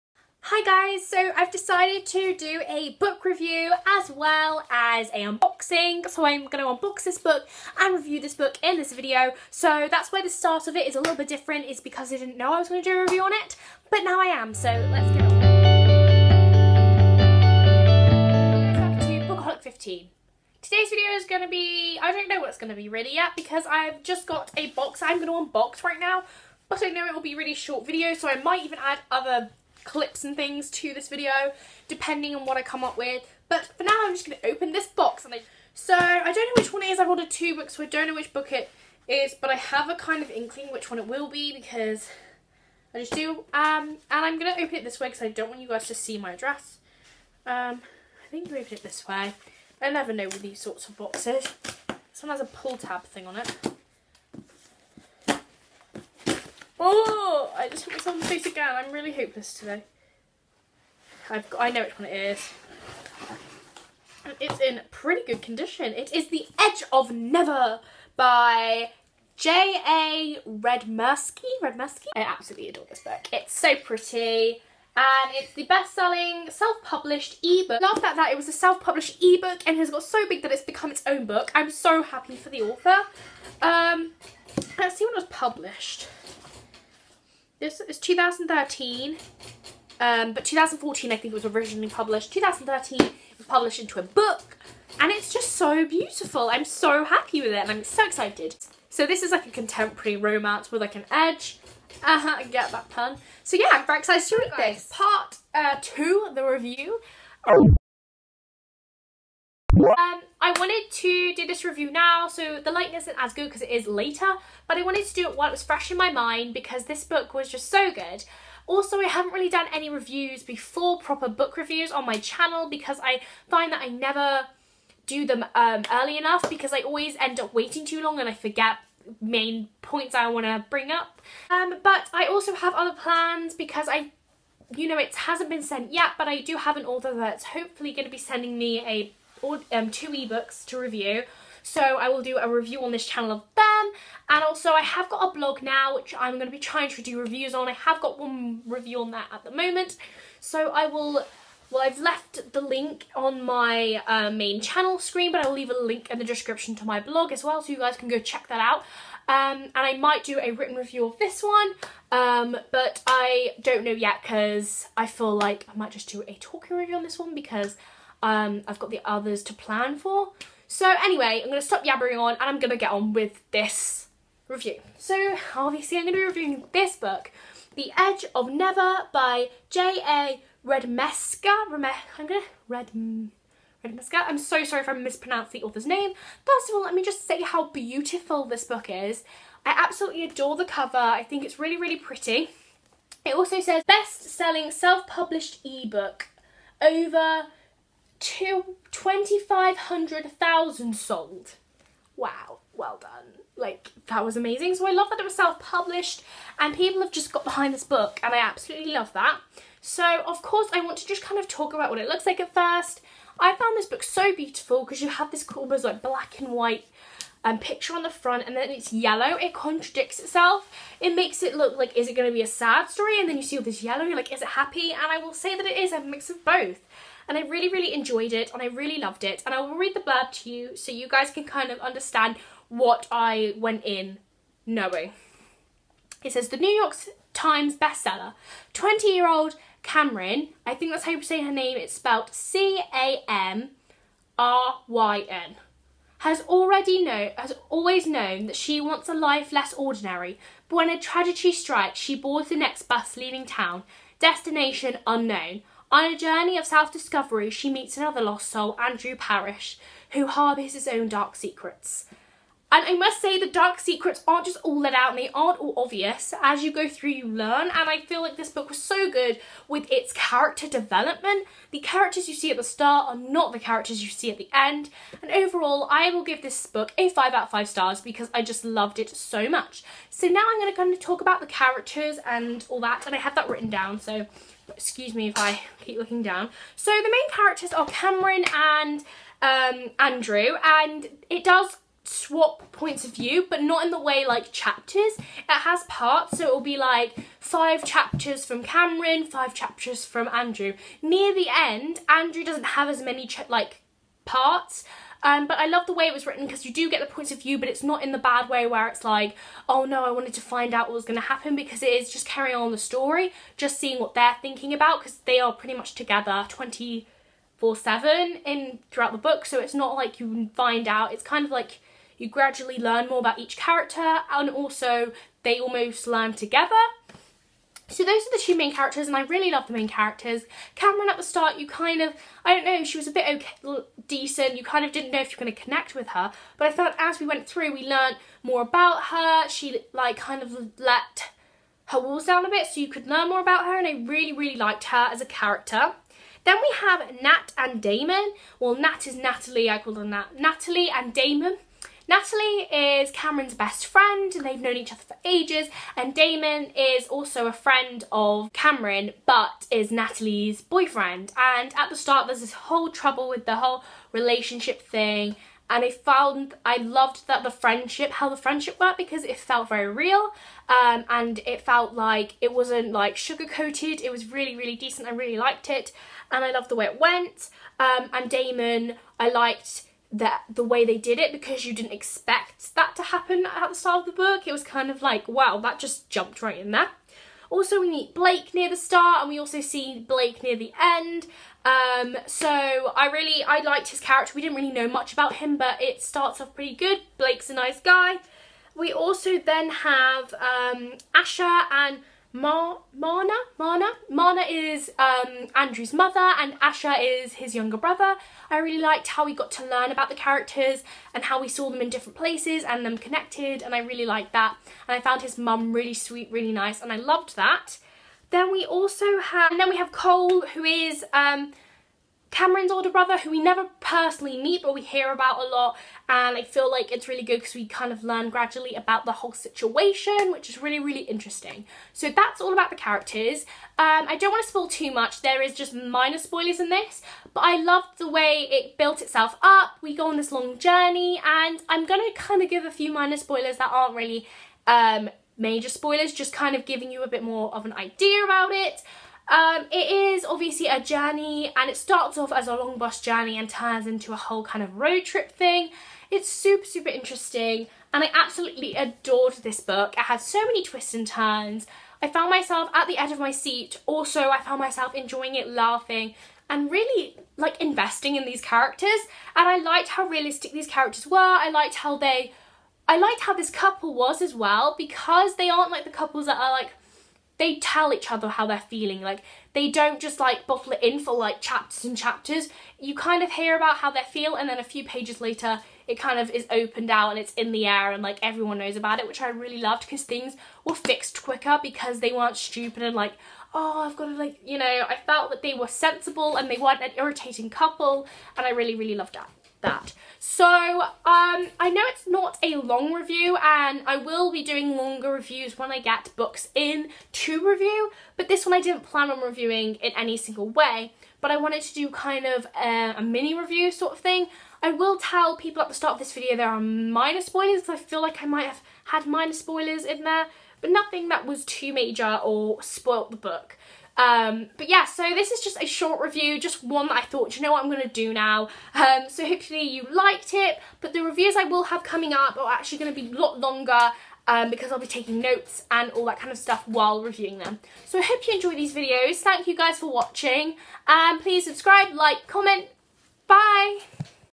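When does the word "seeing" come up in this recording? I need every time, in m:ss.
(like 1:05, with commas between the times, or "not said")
5:13.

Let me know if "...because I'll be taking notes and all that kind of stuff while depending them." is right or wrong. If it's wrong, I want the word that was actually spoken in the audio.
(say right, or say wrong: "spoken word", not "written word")
wrong: "reviewing", not "depending".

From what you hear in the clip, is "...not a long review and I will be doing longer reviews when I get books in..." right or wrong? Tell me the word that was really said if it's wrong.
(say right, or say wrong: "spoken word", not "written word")
right.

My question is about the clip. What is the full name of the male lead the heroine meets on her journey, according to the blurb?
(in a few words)
Andrew Parrish.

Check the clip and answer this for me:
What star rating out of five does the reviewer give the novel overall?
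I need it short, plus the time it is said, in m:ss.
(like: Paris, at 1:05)
5, at 4:37.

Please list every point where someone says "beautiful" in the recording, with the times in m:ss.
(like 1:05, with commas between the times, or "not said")
1:35, 3:07, 3:34.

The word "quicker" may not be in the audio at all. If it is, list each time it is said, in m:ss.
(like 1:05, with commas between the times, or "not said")
8:11.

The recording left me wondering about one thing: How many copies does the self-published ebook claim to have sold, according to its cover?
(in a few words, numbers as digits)
2,500,000.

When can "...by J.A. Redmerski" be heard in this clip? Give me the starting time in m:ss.
1:08.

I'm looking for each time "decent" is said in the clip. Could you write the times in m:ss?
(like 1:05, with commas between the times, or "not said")
5:34, 6:14.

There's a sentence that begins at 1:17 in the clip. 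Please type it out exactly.
Laughed that that it was a self-published ebook and has got so big that it's become its own book.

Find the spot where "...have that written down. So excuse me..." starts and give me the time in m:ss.
4:43.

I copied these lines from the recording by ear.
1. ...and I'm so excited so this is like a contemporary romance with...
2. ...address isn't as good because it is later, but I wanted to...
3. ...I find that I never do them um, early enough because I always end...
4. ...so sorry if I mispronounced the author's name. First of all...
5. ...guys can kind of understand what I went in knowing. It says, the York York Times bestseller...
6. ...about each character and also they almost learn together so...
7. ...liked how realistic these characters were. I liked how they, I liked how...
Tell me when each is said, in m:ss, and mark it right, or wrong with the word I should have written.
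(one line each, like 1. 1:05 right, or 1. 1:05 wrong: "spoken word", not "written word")
1. 1:37 right
2. 1:52 wrong: "lightness", not "address"
3. 2:03 right
4. 3:04 right
5. 3:51 wrong: "New", not "York"
6. 5:23 right
7. 7:49 right.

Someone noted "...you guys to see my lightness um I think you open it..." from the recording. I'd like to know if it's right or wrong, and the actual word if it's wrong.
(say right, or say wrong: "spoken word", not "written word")
wrong: "address", not "lightness".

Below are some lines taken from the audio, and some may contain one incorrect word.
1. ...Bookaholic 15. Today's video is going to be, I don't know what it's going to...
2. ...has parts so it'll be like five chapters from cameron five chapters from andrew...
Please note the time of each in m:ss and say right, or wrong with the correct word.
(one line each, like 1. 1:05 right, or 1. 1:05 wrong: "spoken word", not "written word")
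1. 0:19 right
2. 4:55 right.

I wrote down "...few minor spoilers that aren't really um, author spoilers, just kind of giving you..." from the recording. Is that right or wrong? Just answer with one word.
wrong.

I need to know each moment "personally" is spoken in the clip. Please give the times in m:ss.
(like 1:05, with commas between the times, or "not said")
7:03.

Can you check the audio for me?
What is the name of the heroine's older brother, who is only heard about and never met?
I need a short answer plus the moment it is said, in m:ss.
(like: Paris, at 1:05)
Cole, at 6:59.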